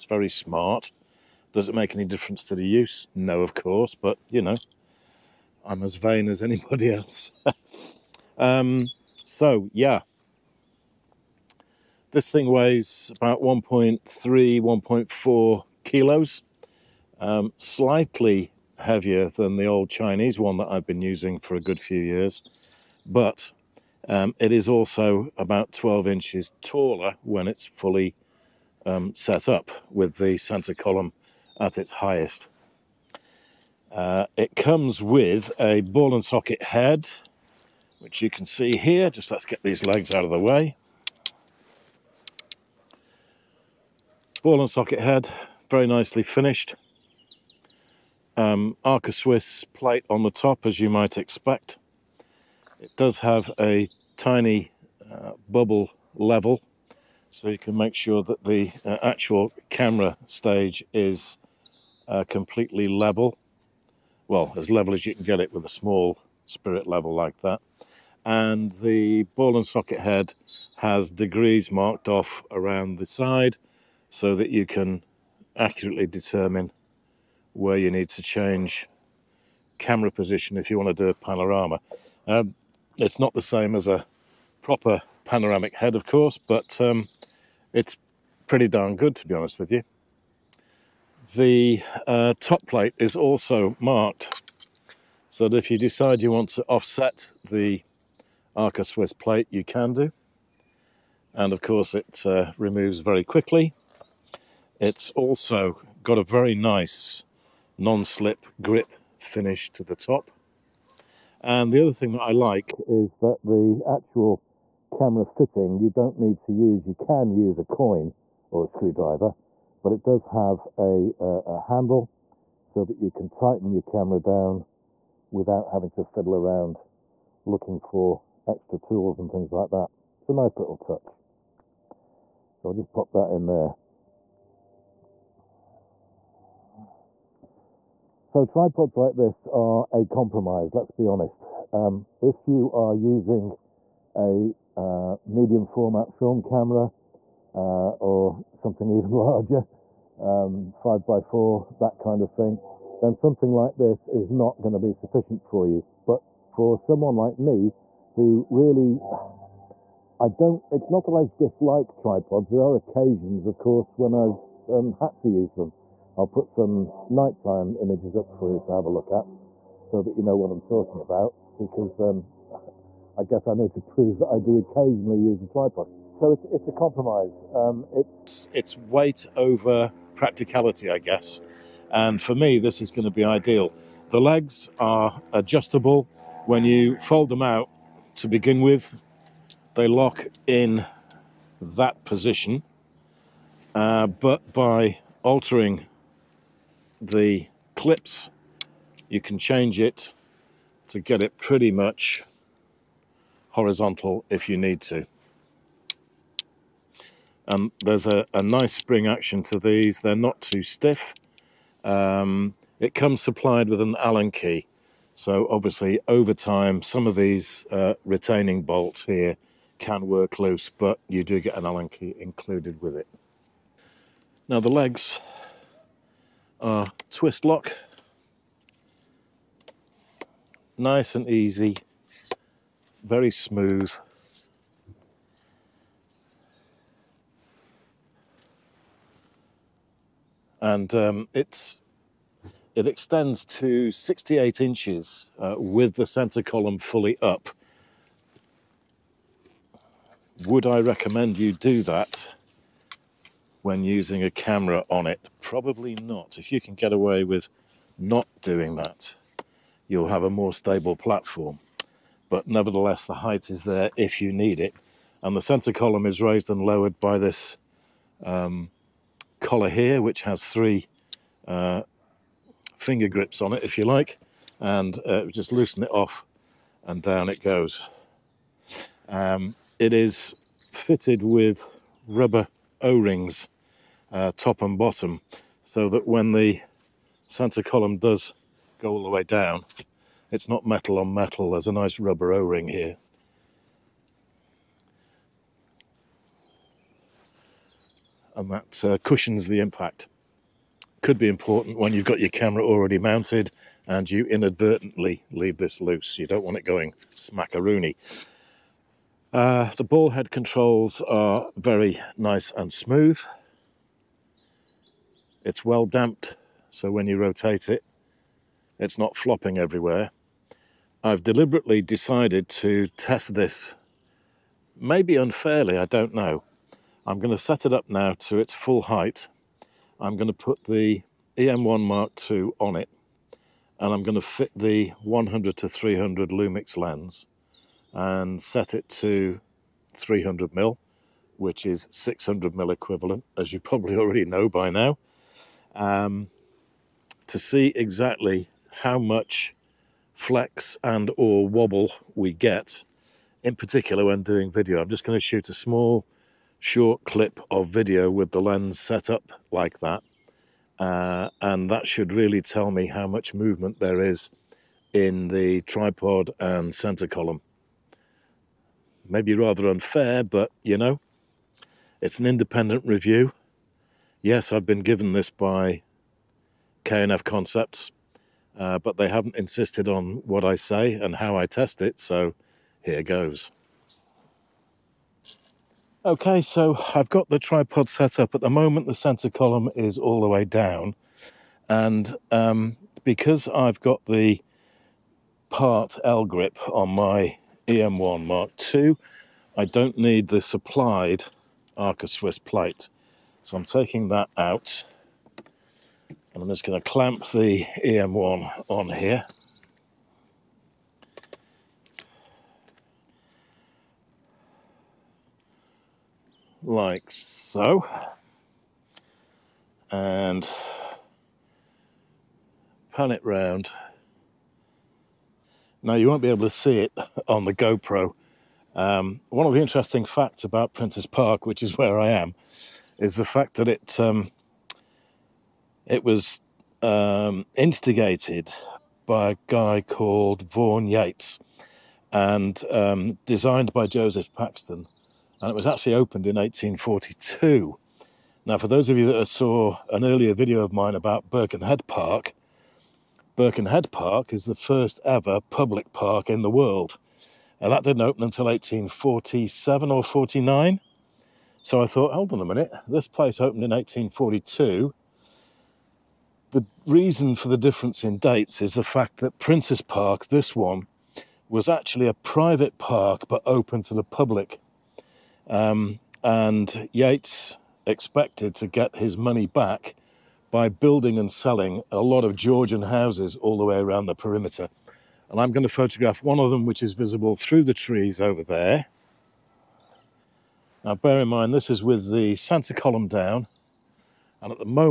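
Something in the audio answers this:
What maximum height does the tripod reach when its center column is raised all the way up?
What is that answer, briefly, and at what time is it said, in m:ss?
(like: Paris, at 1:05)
68 inches, at 4:03.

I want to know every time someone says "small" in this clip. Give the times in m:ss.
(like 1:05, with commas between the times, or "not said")
1:05, 5:55.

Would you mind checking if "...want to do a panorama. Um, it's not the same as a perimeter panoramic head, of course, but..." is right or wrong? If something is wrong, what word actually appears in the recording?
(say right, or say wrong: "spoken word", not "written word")
wrong: "proper", not "perimeter".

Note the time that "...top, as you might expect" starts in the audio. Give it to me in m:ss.
0:50.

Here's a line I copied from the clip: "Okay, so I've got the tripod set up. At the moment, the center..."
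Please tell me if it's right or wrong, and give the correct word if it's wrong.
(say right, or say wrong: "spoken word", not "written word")
right.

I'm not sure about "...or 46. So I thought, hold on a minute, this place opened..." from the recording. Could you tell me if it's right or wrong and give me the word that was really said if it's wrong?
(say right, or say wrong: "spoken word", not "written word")
wrong: "49", not "46".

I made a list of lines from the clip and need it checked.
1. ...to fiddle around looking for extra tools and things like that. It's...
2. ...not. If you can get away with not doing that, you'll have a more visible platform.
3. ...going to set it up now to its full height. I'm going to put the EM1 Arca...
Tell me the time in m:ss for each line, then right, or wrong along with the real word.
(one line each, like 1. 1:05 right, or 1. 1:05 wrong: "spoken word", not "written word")
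1. 2:05 right
2. 4:15 wrong: "stable", not "visible"
3. 5:27 wrong: "Mark", not "Arca".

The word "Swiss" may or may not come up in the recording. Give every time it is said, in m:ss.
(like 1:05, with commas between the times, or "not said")
0:49, 1:38, 6:42.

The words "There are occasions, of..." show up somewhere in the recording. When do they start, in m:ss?
2:42.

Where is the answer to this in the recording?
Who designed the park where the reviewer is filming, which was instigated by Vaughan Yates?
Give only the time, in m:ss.
7:23.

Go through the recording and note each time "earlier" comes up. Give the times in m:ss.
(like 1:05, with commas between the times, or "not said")
7:30.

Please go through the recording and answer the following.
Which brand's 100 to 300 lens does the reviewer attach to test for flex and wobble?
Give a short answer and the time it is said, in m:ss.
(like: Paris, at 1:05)
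Lumix, at 5:36.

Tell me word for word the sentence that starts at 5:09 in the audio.
Uh, the ball head controls are very nice and smooth.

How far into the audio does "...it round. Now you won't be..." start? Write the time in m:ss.
7:03.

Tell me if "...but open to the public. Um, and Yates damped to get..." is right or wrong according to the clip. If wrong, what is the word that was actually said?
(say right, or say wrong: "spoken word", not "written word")
wrong: "expected", not "damped".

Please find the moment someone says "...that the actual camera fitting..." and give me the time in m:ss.
1:53.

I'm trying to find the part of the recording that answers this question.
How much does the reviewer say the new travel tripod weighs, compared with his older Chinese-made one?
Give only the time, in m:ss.
0:13.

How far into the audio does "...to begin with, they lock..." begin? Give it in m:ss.
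3:08.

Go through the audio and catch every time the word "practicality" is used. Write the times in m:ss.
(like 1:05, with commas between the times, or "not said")
3:00.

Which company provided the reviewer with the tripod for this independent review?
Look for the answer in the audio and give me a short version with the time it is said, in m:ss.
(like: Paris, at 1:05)
K&F Concepts, at 6:16.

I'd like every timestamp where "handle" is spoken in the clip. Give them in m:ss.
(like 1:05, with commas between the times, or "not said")
2:01.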